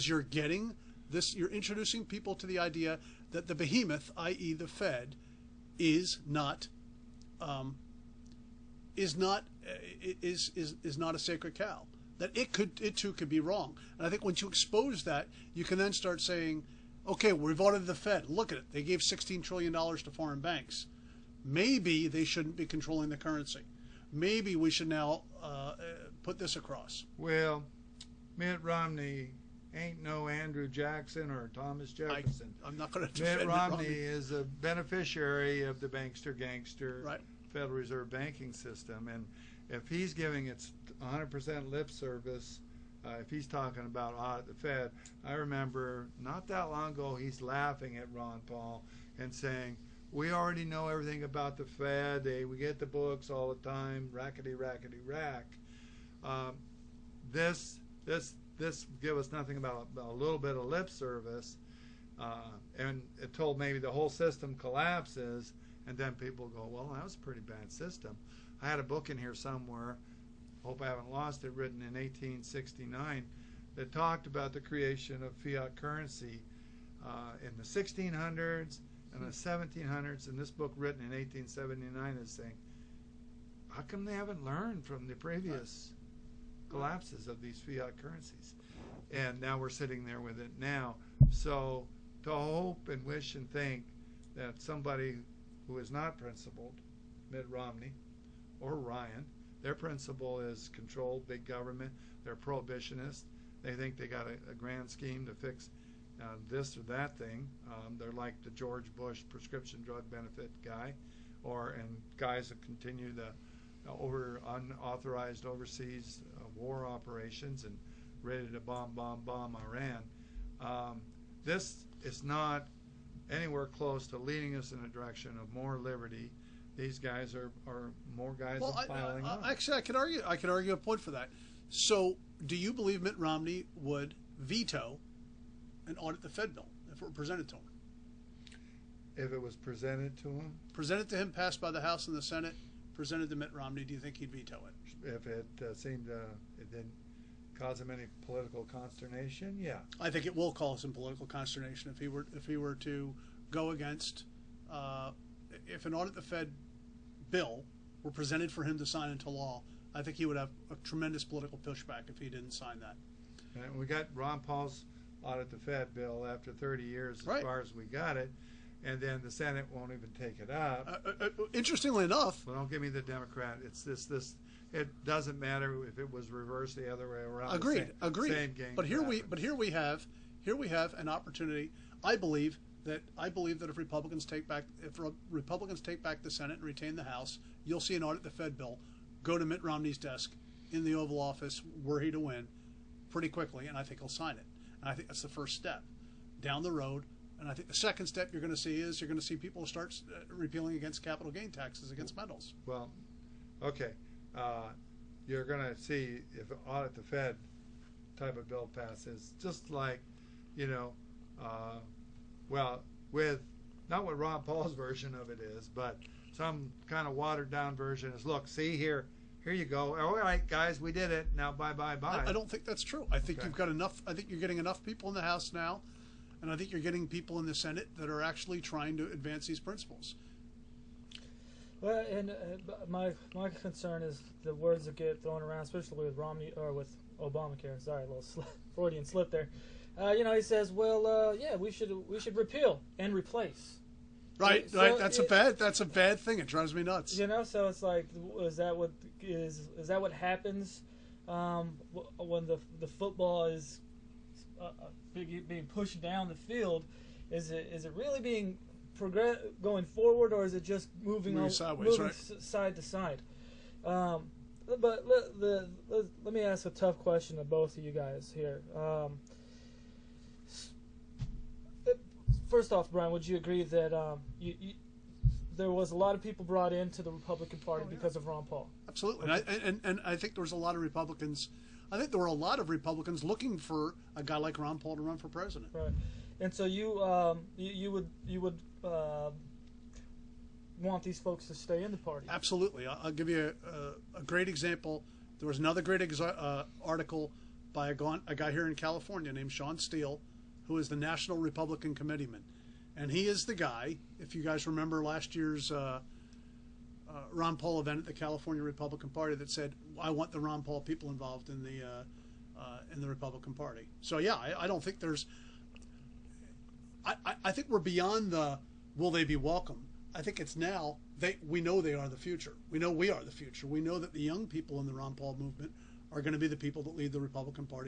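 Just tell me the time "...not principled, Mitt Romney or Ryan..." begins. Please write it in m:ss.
1:35.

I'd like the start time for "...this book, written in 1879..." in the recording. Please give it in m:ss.
1:20.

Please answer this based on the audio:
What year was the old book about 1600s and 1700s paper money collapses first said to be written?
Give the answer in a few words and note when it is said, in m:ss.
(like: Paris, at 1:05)
1869, at 1:11.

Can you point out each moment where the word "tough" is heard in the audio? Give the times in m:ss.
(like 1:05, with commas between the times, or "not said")
4:26.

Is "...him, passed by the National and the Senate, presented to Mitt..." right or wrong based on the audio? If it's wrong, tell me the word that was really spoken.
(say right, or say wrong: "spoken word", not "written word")
wrong: "House", not "National".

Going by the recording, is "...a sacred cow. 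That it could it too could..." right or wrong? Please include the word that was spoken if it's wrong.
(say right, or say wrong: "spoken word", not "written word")
right.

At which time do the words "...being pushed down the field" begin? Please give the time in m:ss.
4:15.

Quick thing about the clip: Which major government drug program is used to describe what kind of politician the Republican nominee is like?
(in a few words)
prescription drug benefit.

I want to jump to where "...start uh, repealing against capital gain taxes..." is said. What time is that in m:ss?
3:19.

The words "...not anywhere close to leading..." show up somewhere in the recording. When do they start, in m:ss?
2:02.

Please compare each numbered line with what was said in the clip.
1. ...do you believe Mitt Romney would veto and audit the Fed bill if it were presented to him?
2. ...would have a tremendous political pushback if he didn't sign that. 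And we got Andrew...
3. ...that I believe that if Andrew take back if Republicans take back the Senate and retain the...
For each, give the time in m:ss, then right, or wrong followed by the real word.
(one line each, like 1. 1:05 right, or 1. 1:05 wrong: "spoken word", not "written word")
1. 2:12 right
2. 2:40 wrong: "Ron", not "Andrew"
3. 3:02 wrong: "Republicans", not "Andrew".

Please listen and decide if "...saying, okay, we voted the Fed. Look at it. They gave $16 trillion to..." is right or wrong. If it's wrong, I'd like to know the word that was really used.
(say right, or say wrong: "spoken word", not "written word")
right.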